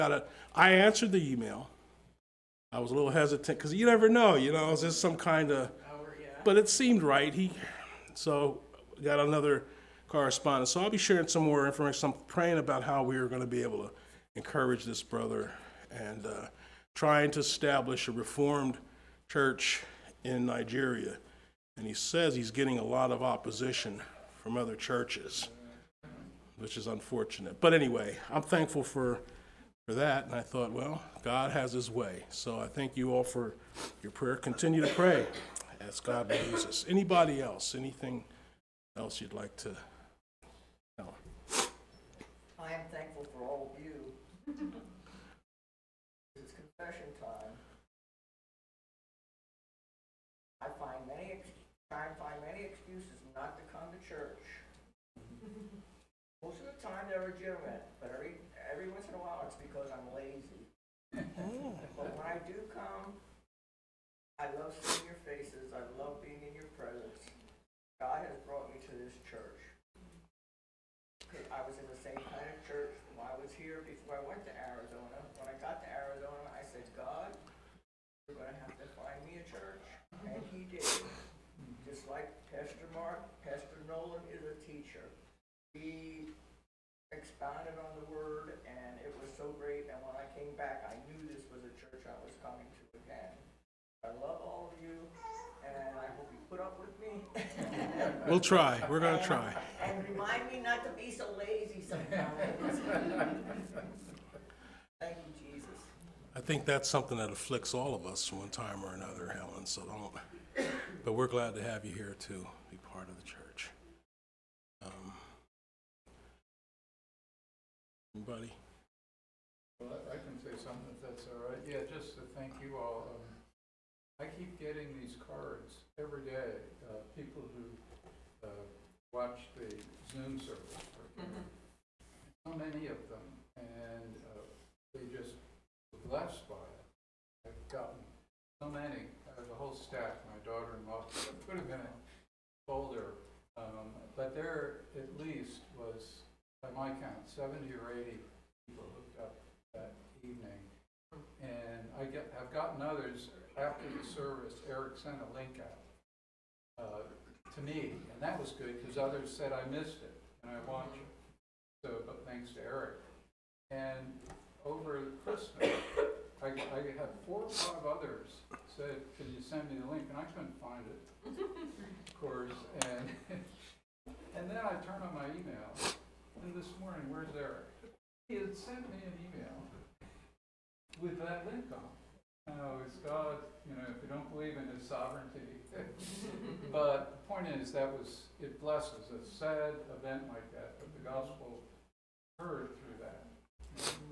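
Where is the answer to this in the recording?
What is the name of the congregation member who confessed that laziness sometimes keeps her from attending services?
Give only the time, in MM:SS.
01:49.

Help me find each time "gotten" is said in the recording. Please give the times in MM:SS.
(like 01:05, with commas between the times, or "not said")
02:17, 02:32.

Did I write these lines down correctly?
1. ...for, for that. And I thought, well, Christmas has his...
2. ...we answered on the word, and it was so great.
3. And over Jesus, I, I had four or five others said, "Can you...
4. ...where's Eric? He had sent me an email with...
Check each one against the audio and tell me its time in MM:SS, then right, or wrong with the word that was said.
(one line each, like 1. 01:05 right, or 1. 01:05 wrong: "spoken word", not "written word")
1. 00:28 wrong: "God", not "Christmas"
2. 01:25 wrong: "expounded", not "answered"
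3. 02:43 wrong: "Christmas", not "Jesus"
4. 02:57 right.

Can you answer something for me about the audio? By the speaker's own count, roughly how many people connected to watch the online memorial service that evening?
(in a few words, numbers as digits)
70 or 80.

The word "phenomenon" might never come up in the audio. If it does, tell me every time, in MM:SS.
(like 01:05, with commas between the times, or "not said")
not said.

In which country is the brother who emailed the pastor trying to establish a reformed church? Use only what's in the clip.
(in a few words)
Nigeria.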